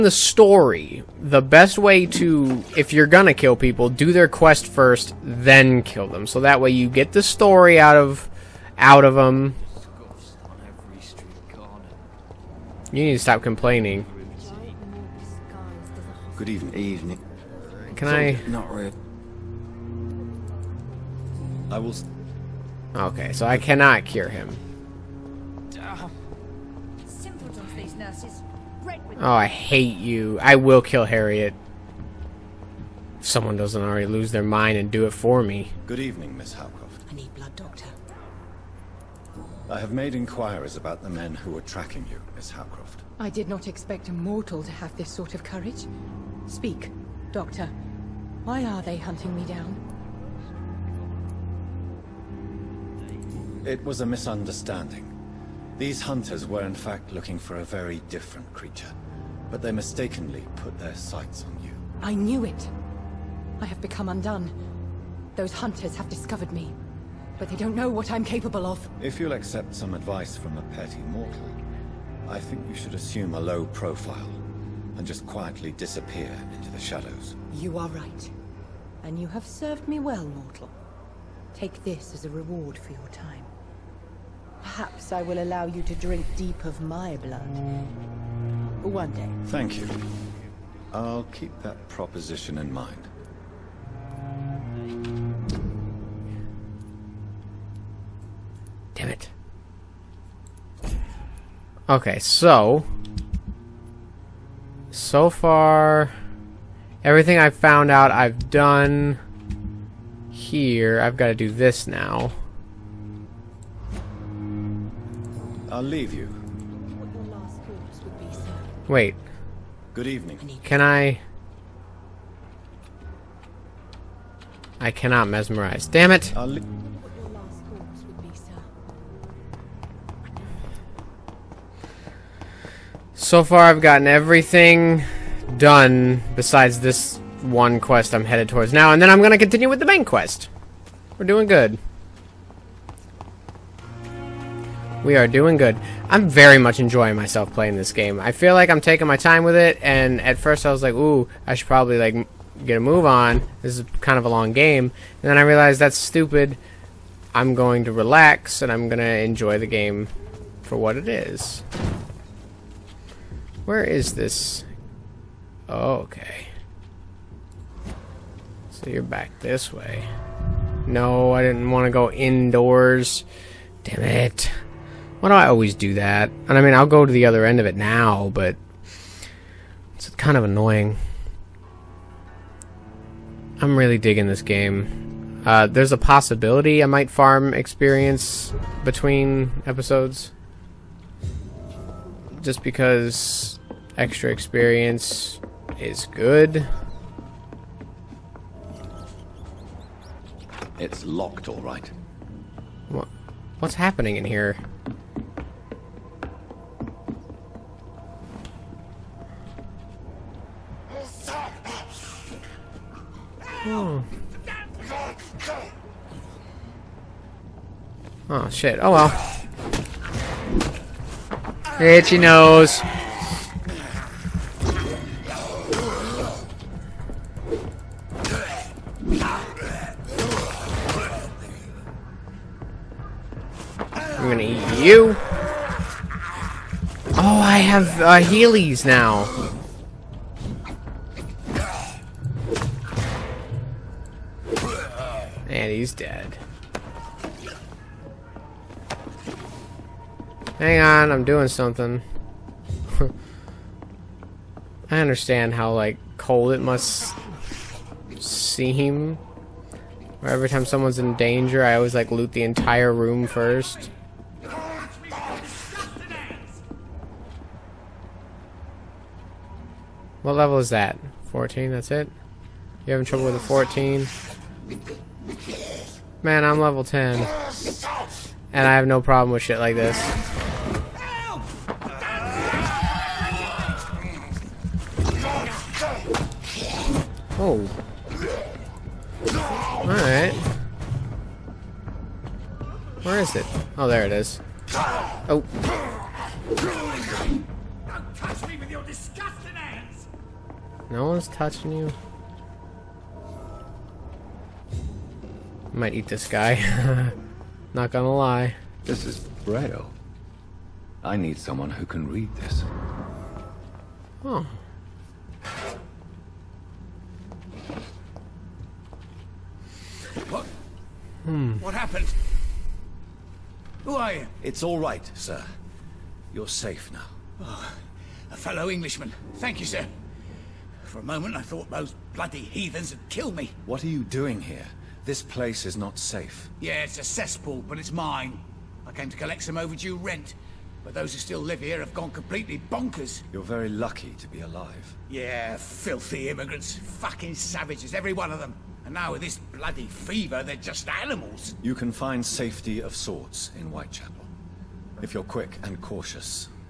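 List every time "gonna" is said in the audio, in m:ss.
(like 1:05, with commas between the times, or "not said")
0:03, 2:19, 3:54, 5:07.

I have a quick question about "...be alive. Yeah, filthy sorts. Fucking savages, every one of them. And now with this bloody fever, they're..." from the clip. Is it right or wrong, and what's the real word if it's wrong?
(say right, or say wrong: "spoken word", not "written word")
wrong: "immigrants", not "sorts".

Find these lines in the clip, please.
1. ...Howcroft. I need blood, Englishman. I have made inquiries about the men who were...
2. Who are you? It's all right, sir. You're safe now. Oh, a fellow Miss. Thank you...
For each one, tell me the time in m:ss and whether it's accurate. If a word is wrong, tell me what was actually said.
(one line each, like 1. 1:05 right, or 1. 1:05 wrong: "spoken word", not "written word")
1. 0:36 wrong: "Doctor", not "Englishman"
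2. 5:23 wrong: "Englishman", not "Miss".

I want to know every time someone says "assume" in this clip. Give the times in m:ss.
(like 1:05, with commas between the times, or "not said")
1:12.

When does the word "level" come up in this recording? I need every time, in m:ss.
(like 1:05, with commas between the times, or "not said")
4:30, 4:36.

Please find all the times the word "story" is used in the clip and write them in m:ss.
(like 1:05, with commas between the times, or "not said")
0:00, 0:07.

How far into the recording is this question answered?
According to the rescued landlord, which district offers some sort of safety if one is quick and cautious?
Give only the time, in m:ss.
5:53.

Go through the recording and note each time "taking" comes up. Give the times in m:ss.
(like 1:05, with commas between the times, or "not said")
2:28.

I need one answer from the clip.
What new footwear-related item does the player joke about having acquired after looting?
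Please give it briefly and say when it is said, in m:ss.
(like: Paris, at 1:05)
Heelys, at 3:58.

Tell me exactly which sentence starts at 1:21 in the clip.
Take this as a reward for your time.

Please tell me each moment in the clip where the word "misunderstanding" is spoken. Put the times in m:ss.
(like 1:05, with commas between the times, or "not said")
0:54.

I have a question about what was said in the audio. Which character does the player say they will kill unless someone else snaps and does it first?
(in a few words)
Harriet.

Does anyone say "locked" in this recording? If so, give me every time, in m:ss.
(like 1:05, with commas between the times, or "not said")
3:21.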